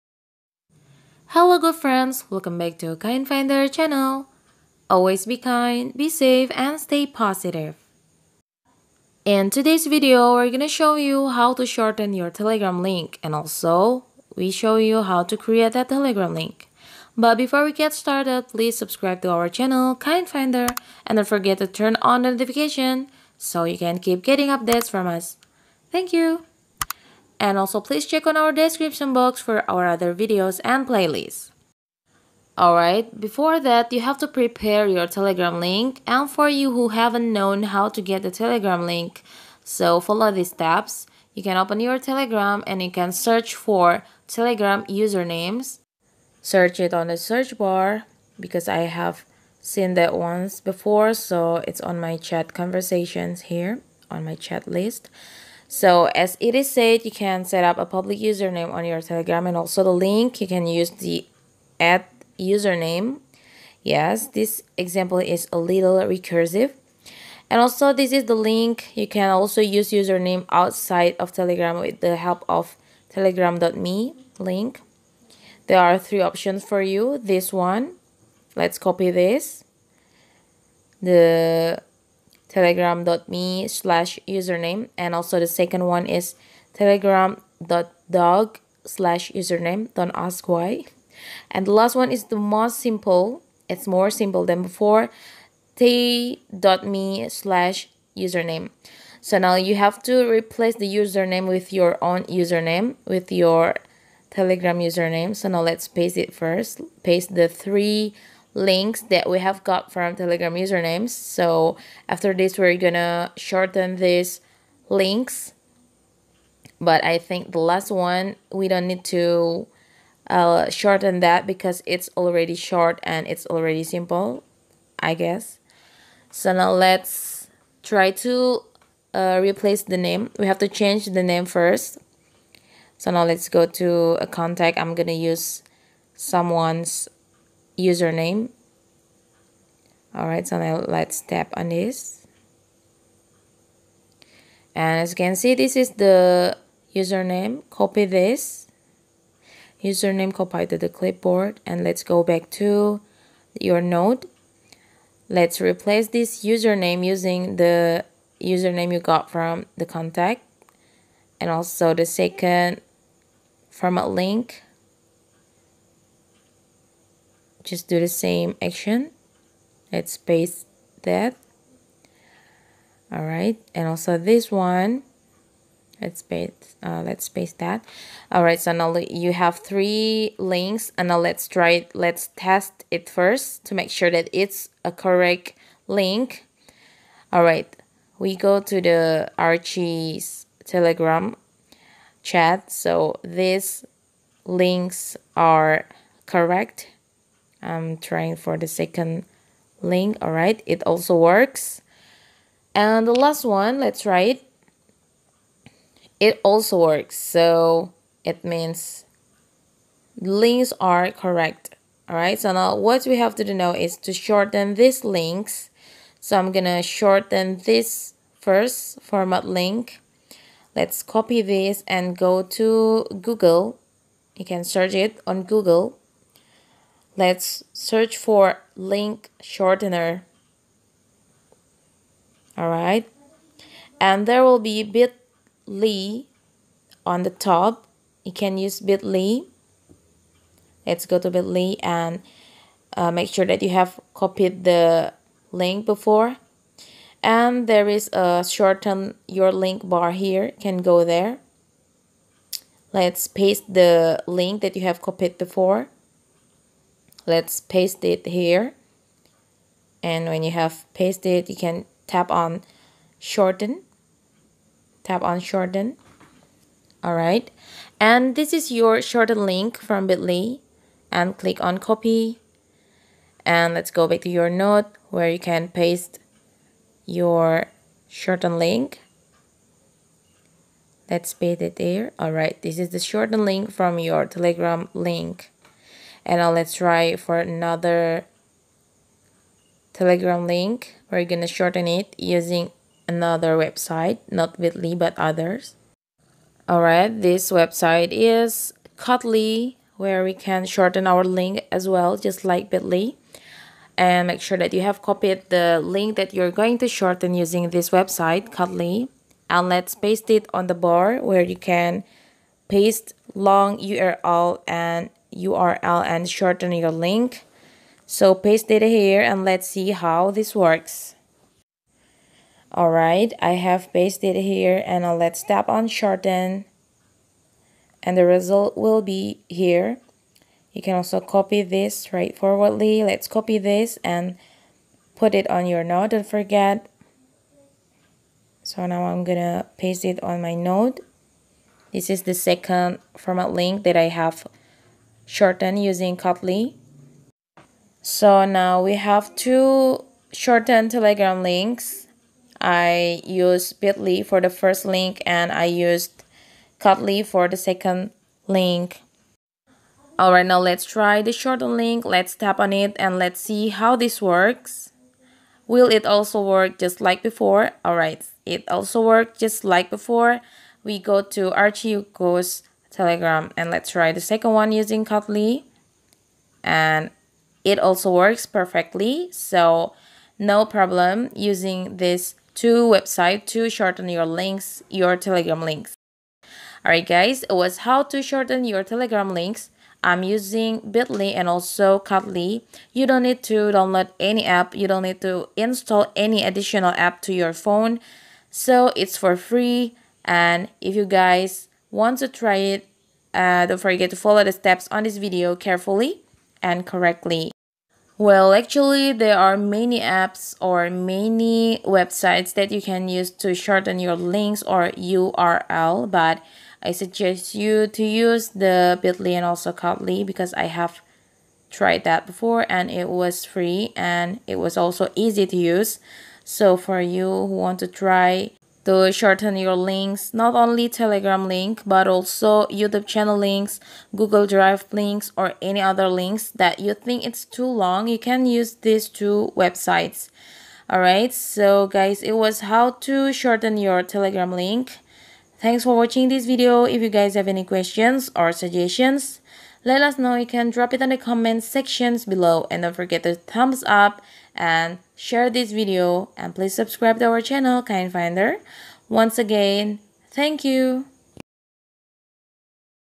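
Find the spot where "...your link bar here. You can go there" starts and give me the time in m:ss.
4:09.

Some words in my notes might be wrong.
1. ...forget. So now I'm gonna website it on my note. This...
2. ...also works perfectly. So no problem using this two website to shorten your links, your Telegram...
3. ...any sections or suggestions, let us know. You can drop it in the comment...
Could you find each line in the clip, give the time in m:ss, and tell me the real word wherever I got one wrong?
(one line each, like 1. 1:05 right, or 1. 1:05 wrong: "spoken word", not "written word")
1. 5:36 wrong: "paste", not "website"
2. 6:17 right
3. 7:27 wrong: "questions", not "sections".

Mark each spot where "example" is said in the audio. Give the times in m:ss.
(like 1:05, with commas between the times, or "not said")
1:04.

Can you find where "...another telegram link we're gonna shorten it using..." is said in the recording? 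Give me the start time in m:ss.
4:47.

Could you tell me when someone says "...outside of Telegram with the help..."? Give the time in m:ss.
1:10.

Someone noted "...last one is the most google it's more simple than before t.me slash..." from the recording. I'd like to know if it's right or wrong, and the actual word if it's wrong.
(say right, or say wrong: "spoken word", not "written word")
wrong: "simple", not "google".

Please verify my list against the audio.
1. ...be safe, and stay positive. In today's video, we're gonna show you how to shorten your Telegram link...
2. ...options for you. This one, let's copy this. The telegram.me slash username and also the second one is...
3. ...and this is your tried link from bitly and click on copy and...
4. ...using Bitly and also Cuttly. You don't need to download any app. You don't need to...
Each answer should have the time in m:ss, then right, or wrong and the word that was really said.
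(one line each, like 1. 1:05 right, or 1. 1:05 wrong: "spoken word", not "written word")
1. 0:05 right
2. 1:16 right
3. 4:27 wrong: "shortened", not "tried"
4. 6:30 right.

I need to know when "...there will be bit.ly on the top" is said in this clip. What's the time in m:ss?
3:54.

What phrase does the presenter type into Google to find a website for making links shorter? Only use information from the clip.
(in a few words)
link shortener.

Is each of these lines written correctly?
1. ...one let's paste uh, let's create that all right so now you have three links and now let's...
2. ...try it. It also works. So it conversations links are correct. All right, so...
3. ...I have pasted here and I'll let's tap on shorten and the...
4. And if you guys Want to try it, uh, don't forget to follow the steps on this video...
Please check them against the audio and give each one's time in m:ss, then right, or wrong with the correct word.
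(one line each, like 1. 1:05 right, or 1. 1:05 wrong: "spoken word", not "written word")
1. 2:54 wrong: "paste", not "create"
2. 3:24 wrong: "means", not "conversations"
3. 5:23 right
4. 6:40 right.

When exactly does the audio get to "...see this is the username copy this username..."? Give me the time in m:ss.
2:25.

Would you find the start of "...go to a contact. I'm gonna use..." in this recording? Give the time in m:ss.
2:13.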